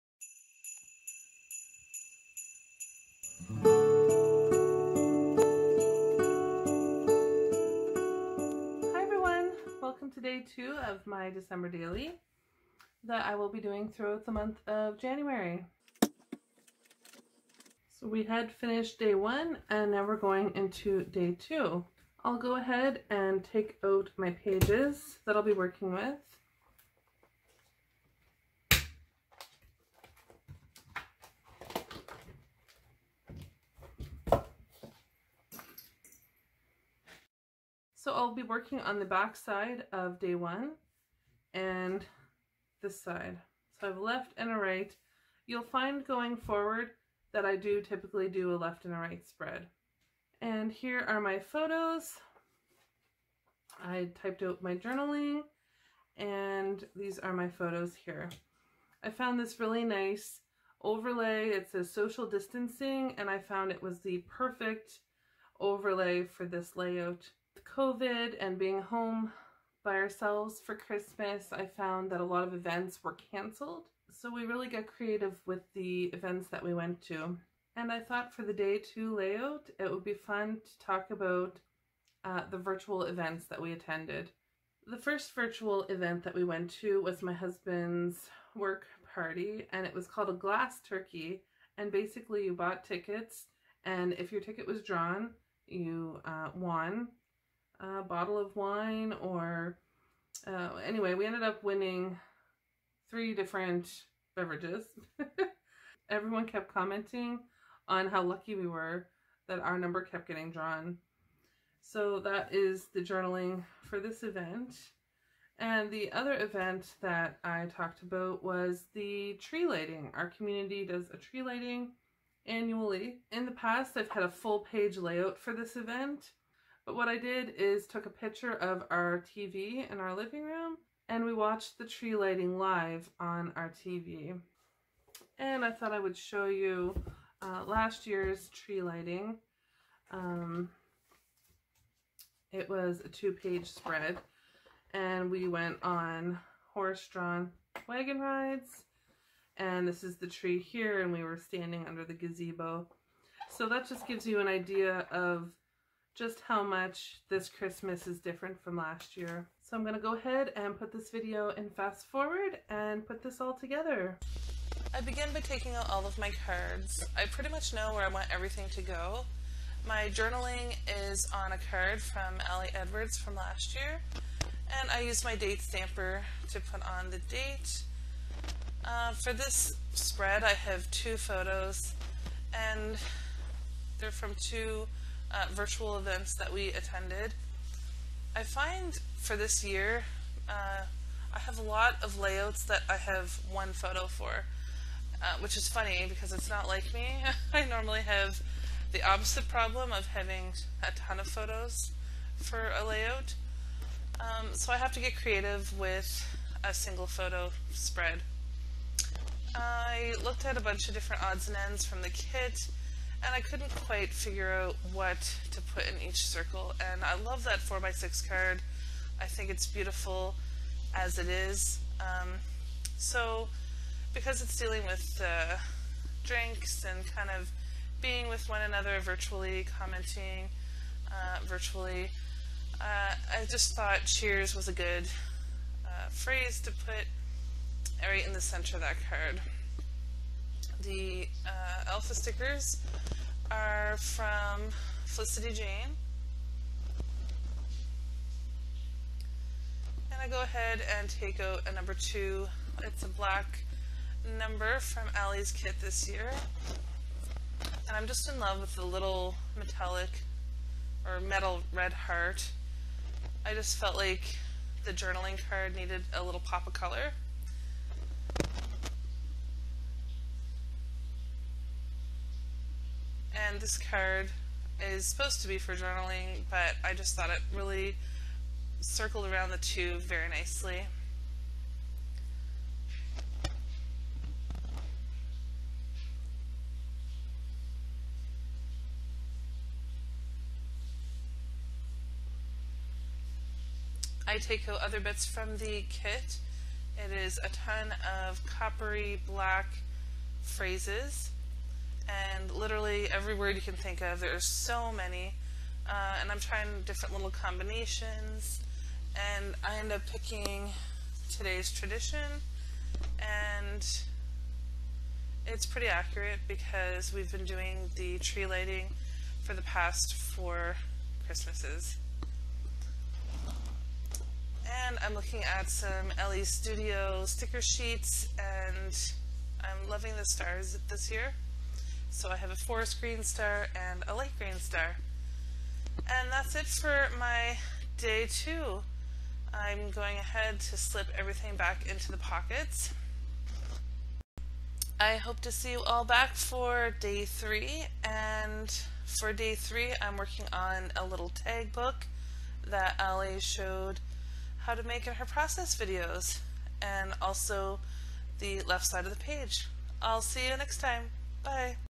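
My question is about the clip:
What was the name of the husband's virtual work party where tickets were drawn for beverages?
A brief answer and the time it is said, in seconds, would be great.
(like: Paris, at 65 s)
glass turkey, at 90 s.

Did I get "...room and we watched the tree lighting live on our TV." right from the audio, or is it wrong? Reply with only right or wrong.
right.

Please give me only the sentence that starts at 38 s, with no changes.
So I'll be working on the back side of day one and this side.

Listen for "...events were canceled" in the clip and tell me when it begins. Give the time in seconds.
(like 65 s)
72 s.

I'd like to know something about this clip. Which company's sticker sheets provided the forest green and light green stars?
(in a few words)
Elle Studio.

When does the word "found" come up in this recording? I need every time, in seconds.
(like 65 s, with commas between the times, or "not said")
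59 s, 63 s, 71 s.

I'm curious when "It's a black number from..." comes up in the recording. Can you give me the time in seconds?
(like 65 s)
252 s.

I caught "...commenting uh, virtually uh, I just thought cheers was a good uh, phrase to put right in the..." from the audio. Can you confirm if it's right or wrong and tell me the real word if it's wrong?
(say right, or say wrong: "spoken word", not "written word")
right.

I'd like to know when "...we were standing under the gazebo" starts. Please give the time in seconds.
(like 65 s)
151 s.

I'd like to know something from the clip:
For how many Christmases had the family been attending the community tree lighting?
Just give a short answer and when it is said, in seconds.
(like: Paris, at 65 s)
4, at 320 s.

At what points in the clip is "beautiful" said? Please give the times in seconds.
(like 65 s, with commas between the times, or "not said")
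219 s.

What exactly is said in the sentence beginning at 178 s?
Uh, for this spread, I have two photos, and they're from two uh, virtual events that we attended.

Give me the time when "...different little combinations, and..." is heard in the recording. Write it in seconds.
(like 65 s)
306 s.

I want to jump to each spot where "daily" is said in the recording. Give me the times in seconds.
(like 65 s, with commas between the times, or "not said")
11 s.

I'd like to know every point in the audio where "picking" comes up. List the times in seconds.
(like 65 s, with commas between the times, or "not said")
310 s.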